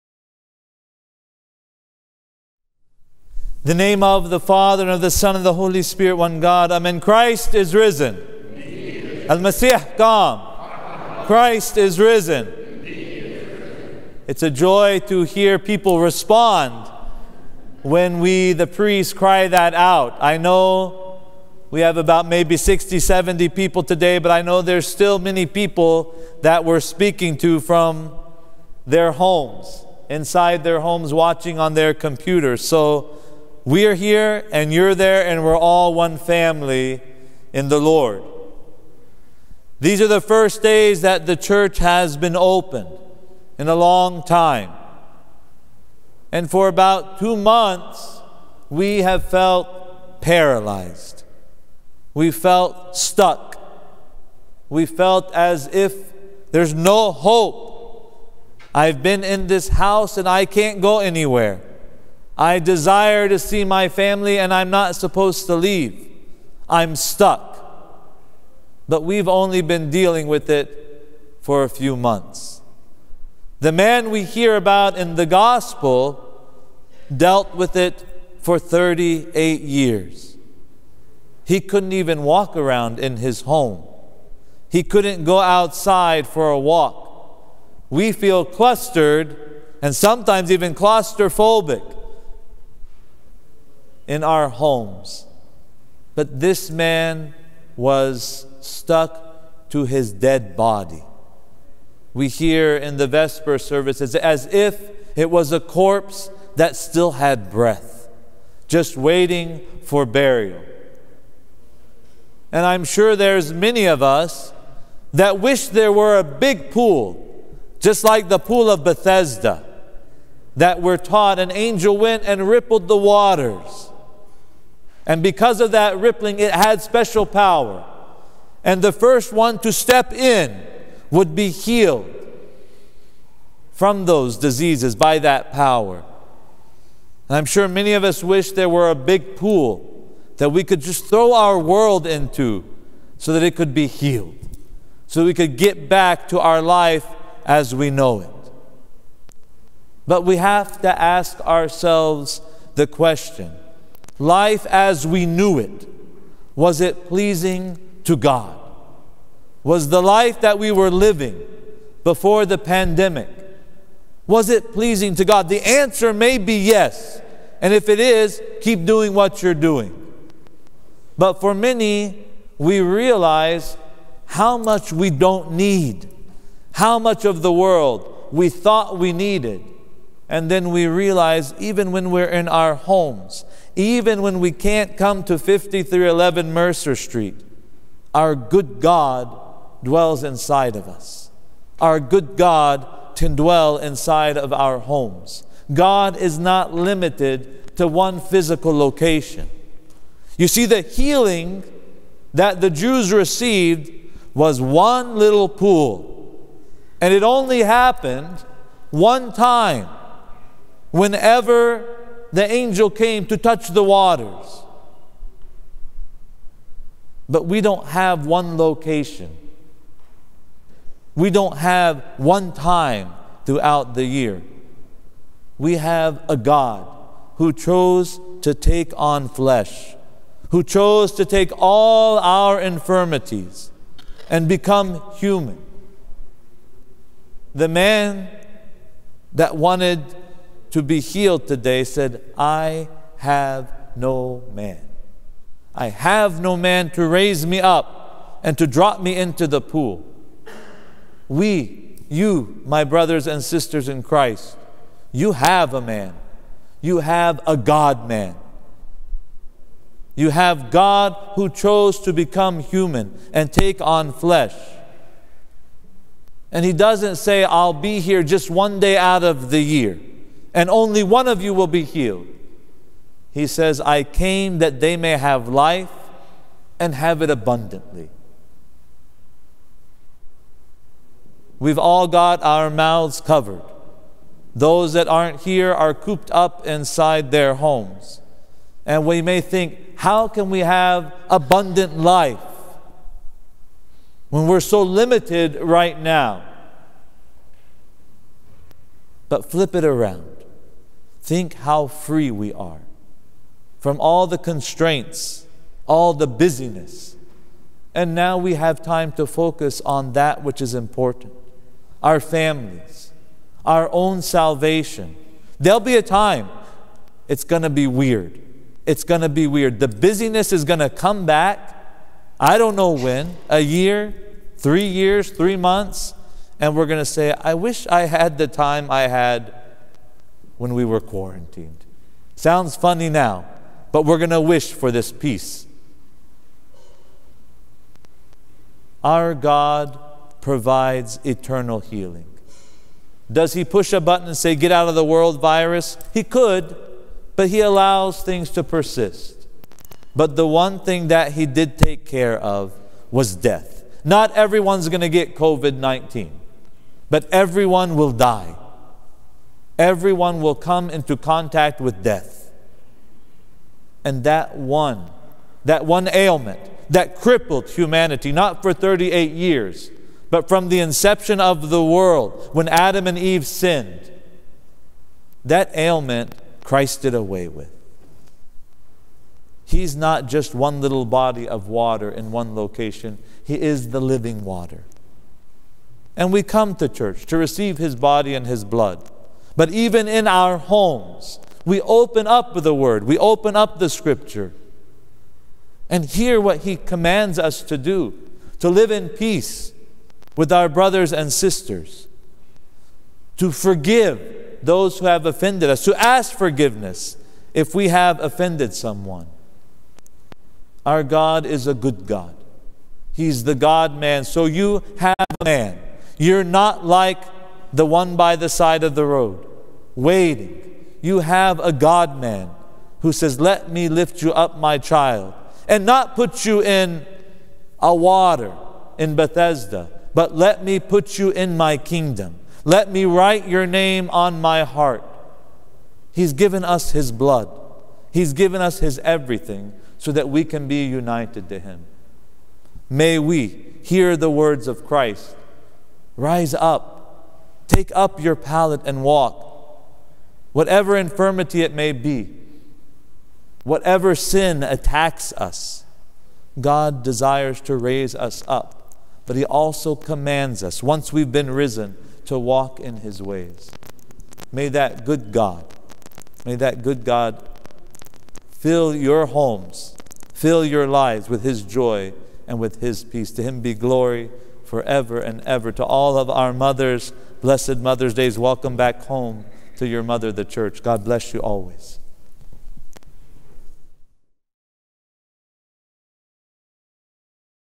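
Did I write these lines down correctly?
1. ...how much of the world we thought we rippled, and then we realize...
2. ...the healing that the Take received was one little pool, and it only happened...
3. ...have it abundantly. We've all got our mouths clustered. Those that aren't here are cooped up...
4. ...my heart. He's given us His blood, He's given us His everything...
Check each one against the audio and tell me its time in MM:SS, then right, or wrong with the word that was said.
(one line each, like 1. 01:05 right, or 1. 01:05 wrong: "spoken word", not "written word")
1. 02:56 wrong: "needed", not "rippled"
2. 03:20 wrong: "Jews", not "Take"
3. 04:36 wrong: "covered", not "clustered"
4. 07:14 right.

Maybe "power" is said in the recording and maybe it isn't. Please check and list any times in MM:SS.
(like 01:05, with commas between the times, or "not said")
02:07, 02:15.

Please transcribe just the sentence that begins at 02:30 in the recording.
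But we have to ask ourselves the question life as we knew it, was it pleasing to God?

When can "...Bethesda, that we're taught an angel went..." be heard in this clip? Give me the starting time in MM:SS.
01:58.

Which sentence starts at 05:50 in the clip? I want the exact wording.
But the one thing that He did take care of was death.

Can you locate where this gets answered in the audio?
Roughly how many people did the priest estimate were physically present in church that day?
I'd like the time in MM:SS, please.
00:22.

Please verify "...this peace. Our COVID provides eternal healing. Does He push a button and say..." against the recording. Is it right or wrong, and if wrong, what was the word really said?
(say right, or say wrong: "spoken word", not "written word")
wrong: "God", not "COVID".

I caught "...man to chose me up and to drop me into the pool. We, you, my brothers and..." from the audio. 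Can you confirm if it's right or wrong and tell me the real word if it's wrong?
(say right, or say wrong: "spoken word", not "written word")
wrong: "raise", not "chose".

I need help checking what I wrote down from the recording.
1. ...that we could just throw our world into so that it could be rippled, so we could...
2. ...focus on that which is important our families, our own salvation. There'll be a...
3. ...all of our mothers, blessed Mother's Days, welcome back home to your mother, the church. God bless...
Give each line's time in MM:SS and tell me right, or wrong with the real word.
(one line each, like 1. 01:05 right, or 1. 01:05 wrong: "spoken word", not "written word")
1. 02:20 wrong: "healed", not "rippled"
2. 05:09 right
3. 07:55 right.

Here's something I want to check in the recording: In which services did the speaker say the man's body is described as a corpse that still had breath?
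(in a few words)
Vesper services.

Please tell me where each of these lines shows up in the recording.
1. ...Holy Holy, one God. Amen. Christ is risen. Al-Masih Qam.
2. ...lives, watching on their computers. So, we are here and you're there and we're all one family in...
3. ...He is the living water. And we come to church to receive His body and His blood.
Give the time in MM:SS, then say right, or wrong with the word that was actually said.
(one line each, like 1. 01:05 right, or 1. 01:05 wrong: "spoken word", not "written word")
1. 00:05 wrong: "Spirit", not "Holy"
2. 00:30 wrong: "homes", not "lives"
3. 06:23 right.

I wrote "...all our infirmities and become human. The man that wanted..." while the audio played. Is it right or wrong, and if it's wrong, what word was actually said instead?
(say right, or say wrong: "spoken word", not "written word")
right.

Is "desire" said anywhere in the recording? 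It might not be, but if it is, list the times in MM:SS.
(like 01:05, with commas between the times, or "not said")
01:02, 07:37.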